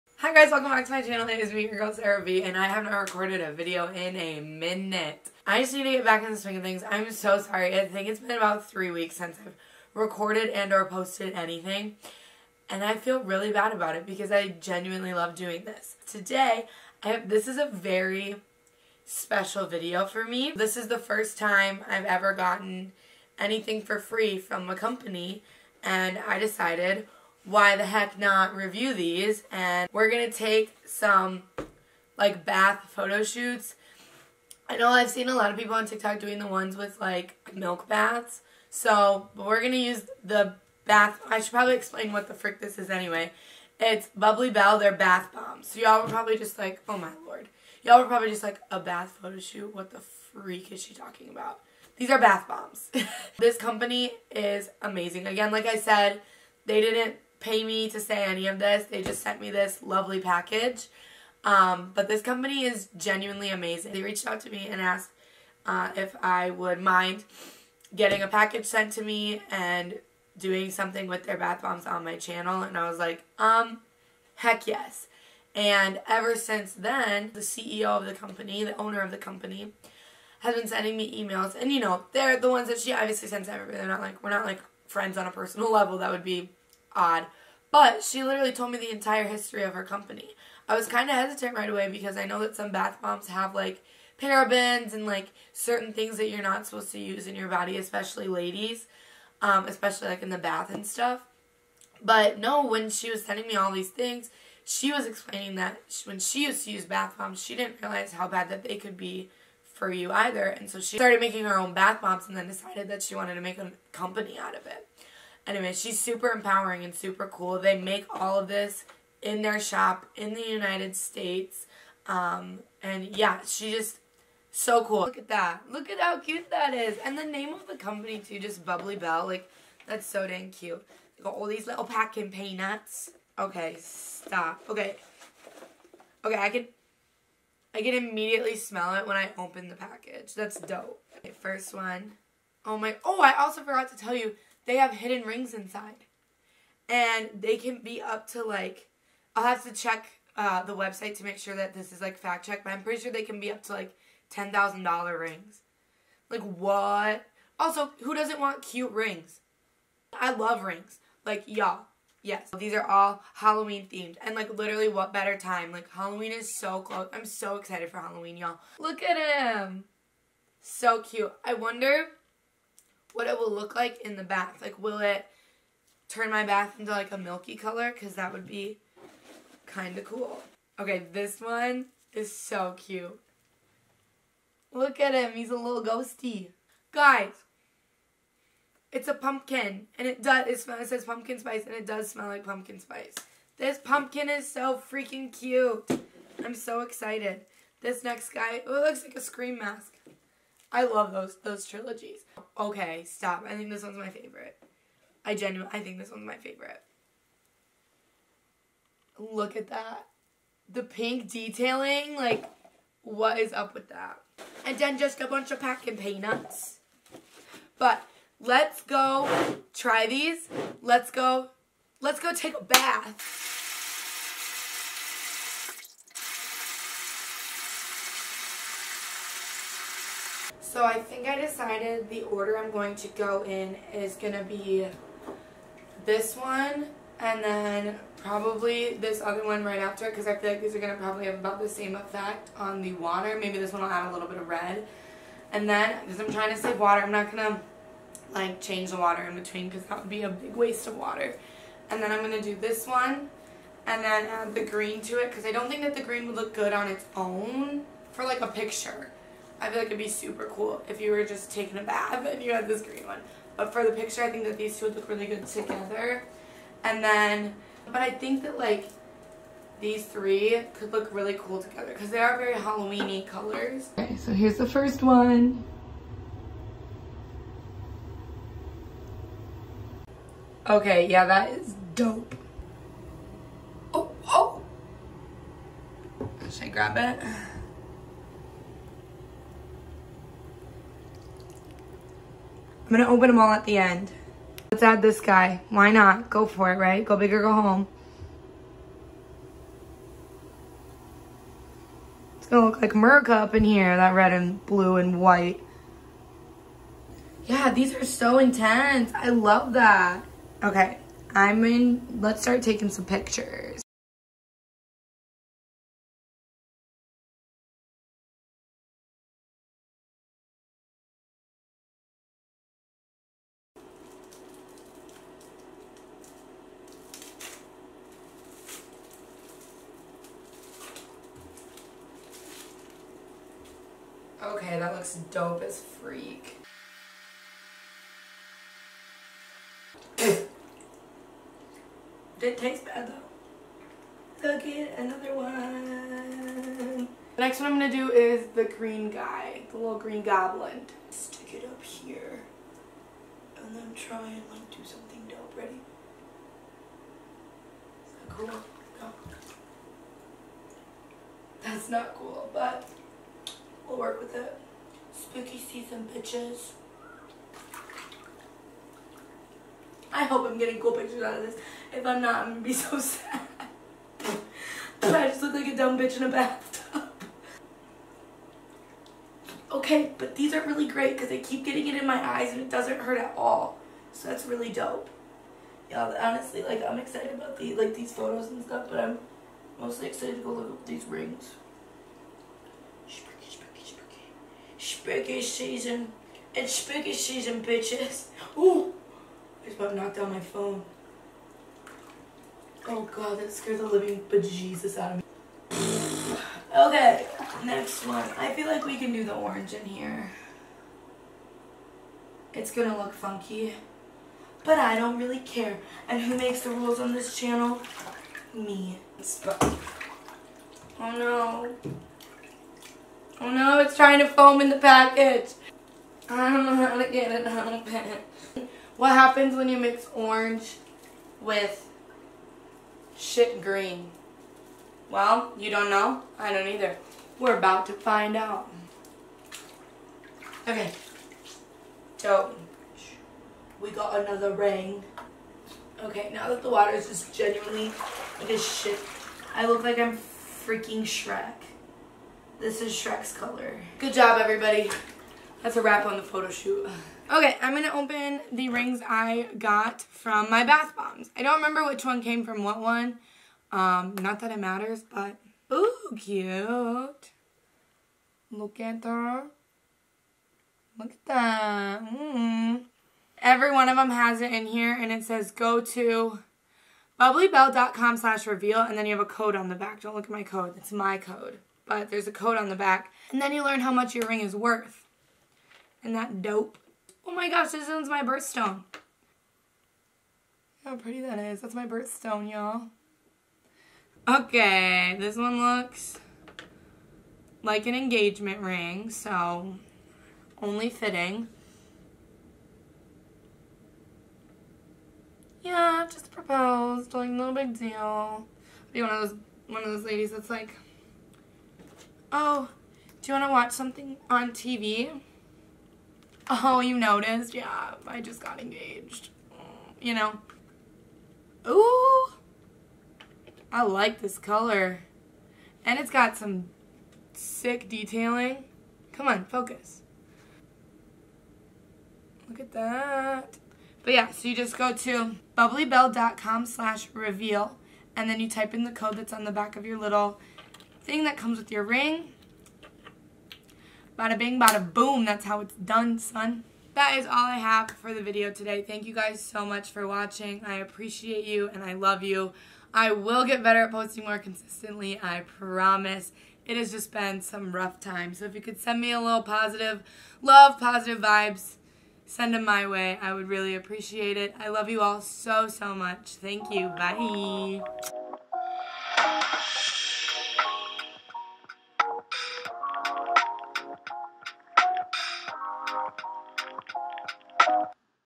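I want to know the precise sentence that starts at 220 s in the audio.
Let's go let's go take a bath.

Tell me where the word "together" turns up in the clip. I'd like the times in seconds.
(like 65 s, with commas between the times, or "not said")
265 s, 271 s.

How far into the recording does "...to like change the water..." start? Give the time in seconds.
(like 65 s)
247 s.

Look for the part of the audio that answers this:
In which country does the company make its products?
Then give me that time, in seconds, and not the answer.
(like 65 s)
120 s.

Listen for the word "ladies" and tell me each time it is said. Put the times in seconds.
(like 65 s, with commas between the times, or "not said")
98 s, 510 s.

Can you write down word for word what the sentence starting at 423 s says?
Oh no, it's trying to foam in the package.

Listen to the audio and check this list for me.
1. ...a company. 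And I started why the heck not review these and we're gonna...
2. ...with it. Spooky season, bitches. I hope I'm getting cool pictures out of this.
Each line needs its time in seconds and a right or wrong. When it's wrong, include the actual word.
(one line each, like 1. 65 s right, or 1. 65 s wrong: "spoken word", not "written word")
1. 24 s wrong: "decided", not "started"
2. 364 s right.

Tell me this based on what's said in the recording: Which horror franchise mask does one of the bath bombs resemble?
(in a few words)
Scream.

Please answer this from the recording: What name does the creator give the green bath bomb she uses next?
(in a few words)
little green goblin.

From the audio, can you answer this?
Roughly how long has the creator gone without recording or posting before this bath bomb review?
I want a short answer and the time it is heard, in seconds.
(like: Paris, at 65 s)
3 weeks, at 8 s.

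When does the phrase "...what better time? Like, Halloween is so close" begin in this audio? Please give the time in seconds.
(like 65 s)
164 s.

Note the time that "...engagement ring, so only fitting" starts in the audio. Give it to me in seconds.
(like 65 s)
497 s.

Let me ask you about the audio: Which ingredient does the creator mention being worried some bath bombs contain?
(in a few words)
parabens.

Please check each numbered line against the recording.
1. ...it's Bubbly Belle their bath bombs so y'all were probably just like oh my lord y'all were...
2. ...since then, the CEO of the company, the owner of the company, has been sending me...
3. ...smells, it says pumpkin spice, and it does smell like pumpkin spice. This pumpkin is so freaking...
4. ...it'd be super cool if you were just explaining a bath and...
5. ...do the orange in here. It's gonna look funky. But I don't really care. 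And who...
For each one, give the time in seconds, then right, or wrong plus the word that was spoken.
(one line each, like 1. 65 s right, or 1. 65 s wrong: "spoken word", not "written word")
1. 43 s right
2. 76 s right
3. 190 s right
4. 259 s wrong: "taking", not "explaining"
5. 409 s right.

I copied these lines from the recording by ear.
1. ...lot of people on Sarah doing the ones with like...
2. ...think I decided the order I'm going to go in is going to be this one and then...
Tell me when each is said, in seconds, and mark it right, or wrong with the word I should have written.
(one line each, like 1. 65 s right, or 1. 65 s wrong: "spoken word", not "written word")
1. 35 s wrong: "TikTok", not "Sarah"
2. 231 s right.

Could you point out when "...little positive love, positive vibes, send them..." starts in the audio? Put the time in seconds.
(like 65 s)
559 s.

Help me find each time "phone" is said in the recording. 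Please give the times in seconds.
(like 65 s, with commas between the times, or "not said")
400 s.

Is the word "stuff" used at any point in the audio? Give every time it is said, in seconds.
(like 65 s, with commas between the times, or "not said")
100 s, 388 s.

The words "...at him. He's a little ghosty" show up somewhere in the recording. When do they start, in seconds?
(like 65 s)
184 s.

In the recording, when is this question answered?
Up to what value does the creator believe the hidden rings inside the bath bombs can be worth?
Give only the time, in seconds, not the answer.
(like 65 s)
154 s.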